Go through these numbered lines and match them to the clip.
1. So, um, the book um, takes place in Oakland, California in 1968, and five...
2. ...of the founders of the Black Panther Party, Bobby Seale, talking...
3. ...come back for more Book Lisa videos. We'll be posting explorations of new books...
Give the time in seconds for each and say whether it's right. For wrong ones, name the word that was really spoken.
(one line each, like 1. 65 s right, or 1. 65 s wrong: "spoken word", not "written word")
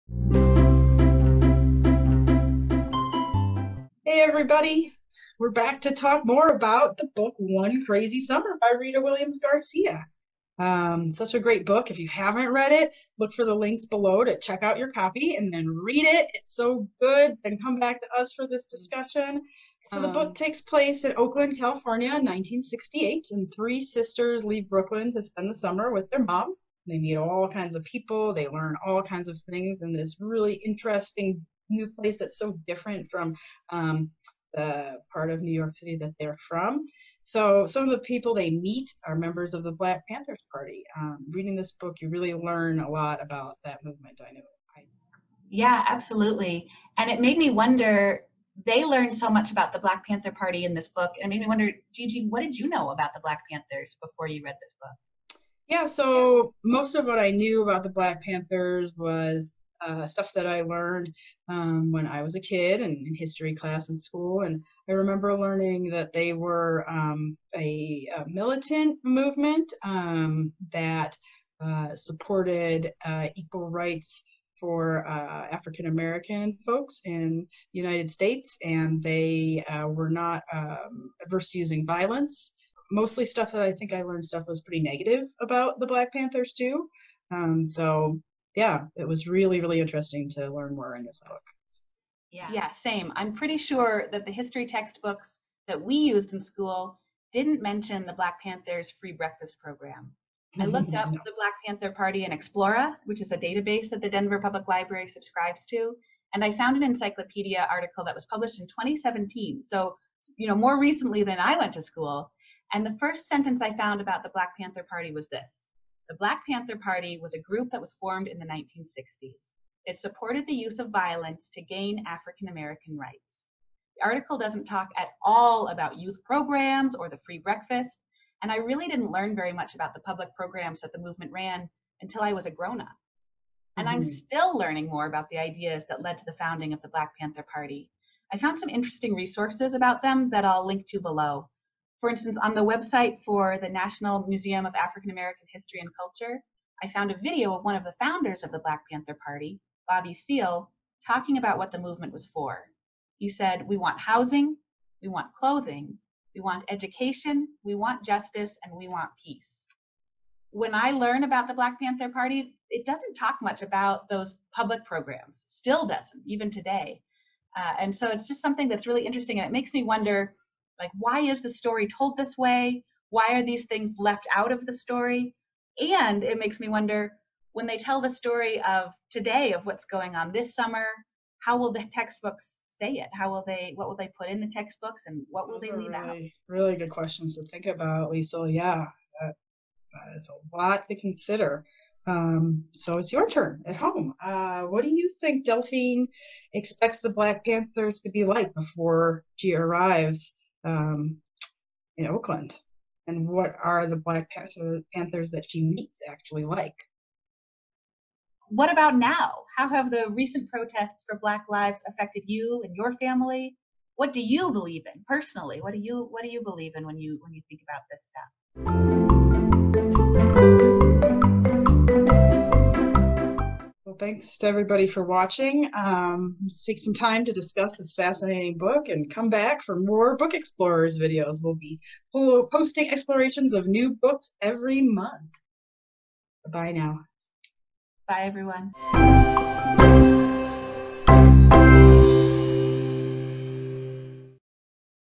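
1. 19 s wrong: "three", not "five"
2. 147 s right
3. 229 s wrong: "Explorers", not "Lisa".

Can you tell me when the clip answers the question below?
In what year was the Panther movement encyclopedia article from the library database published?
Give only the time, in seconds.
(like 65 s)
108 s.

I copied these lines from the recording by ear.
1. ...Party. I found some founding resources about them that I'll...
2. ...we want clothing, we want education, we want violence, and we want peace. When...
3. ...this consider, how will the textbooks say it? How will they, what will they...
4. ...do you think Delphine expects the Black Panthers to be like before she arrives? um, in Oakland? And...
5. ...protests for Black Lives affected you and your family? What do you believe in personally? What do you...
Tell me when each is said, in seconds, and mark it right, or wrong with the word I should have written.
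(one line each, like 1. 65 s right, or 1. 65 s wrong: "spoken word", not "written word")
1. 137 s wrong: "interesting", not "founding"
2. 155 s wrong: "justice", not "violence"
3. 180 s wrong: "summer", not "consider"
4. 194 s right
5. 210 s right.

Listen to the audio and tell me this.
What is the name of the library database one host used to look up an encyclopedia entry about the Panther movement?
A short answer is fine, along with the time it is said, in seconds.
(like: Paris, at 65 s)
Explora, at 102 s.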